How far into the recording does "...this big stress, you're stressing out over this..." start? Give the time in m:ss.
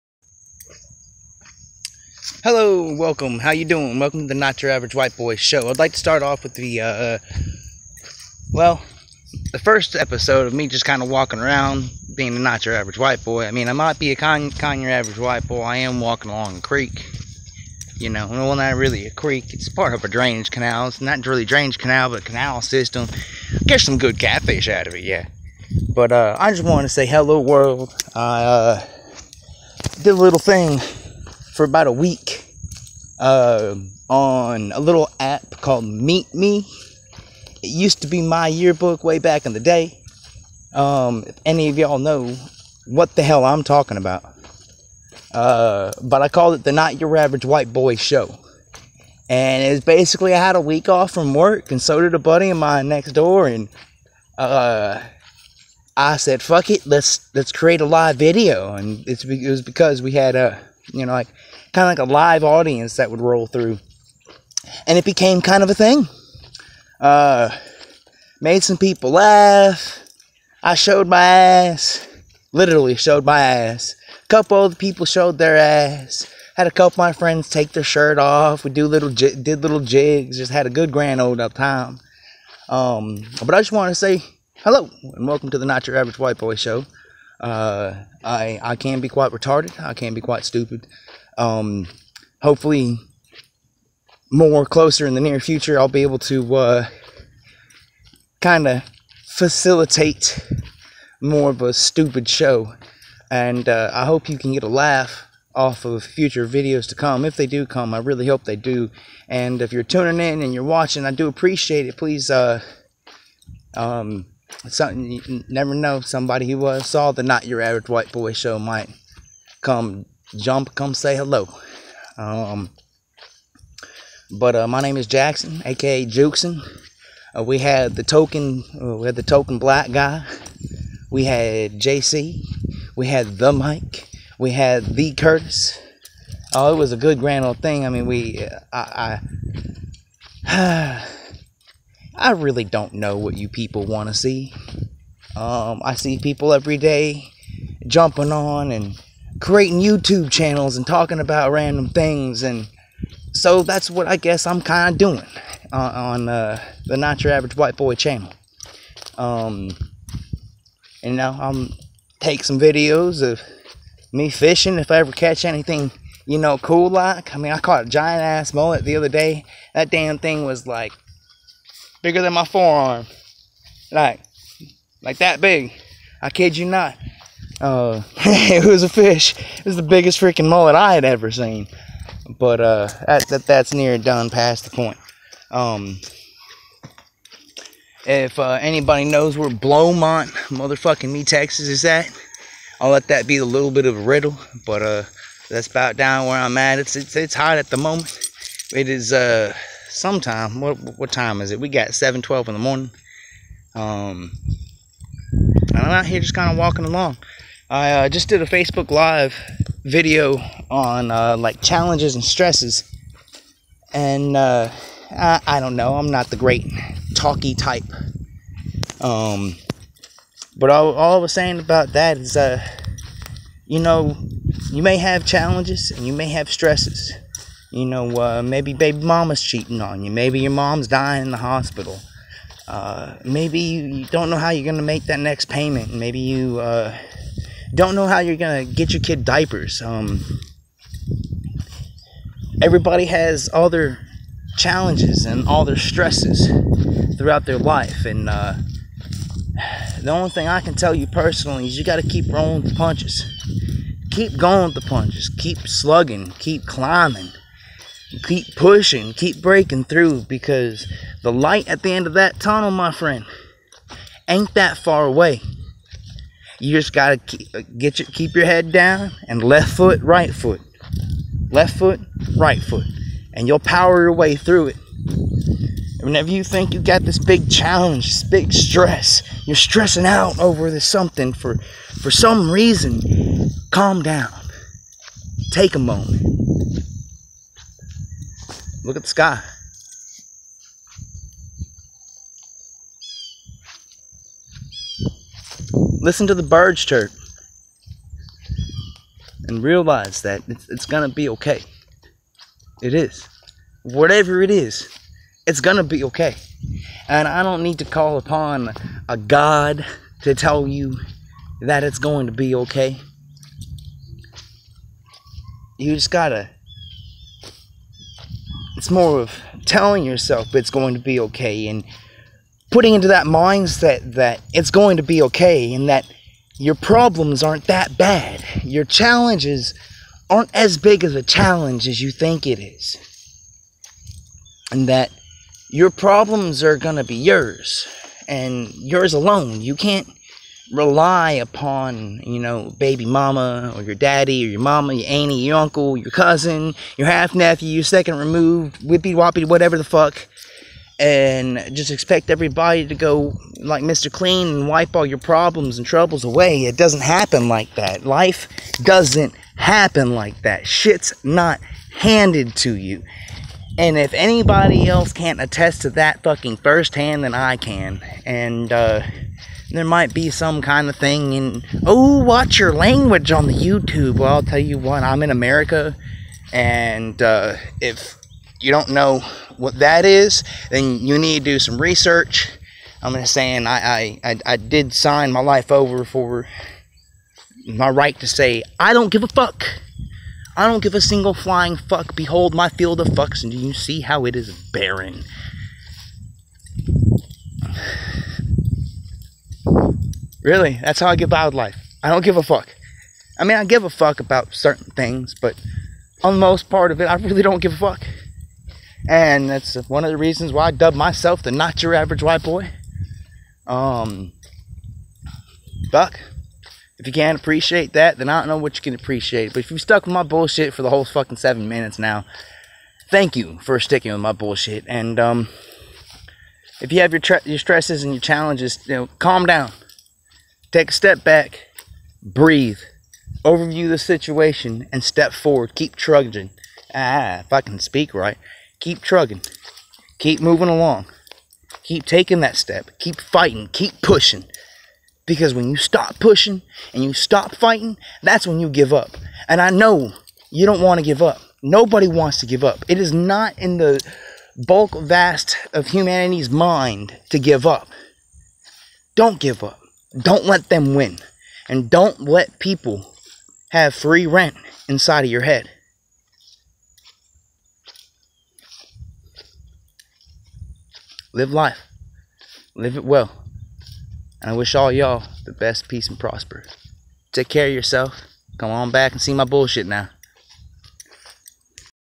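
4:38.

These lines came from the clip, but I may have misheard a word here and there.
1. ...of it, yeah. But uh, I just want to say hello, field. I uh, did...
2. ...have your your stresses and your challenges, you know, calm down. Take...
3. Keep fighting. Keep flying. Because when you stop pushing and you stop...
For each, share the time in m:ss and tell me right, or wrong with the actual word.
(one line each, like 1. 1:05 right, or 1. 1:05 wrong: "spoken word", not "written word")
1. 0:24 wrong: "world", not "field"
2. 7:06 right
3. 7:22 wrong: "pushing", not "flying".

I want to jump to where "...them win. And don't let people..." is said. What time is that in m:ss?
7:40.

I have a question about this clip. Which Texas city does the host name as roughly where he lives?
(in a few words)
Beaumont.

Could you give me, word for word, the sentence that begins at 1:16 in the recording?
Had a couple of my friends take their shirt off.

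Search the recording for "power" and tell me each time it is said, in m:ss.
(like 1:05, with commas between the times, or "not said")
4:33.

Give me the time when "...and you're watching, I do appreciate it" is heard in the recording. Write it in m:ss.
1:50.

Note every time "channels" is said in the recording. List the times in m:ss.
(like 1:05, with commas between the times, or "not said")
2:30, 2:37.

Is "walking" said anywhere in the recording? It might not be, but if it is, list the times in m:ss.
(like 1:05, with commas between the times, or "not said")
0:11, 0:15, 3:26.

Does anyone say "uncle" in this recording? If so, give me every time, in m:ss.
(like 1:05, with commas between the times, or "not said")
5:45.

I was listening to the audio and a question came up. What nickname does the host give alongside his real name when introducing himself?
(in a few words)
Jukeson.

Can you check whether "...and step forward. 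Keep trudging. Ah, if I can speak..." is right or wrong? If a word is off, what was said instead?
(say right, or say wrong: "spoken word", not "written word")
right.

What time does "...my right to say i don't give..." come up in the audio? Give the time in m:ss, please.
6:27.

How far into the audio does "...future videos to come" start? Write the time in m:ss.
1:46.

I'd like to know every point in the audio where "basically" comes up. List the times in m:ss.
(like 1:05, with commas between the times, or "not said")
0:49.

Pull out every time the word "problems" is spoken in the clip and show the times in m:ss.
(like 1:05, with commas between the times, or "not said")
5:26, 5:35, 5:55.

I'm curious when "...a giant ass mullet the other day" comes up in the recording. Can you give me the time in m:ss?
2:47.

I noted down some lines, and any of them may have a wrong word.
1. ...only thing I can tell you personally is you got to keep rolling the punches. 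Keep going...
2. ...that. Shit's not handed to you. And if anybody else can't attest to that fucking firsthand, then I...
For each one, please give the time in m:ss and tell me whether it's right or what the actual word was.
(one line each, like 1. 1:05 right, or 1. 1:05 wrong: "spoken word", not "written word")
1. 4:10 right
2. 6:00 right.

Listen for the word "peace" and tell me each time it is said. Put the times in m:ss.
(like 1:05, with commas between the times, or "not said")
7:55.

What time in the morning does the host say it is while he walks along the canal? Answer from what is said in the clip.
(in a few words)
7:12.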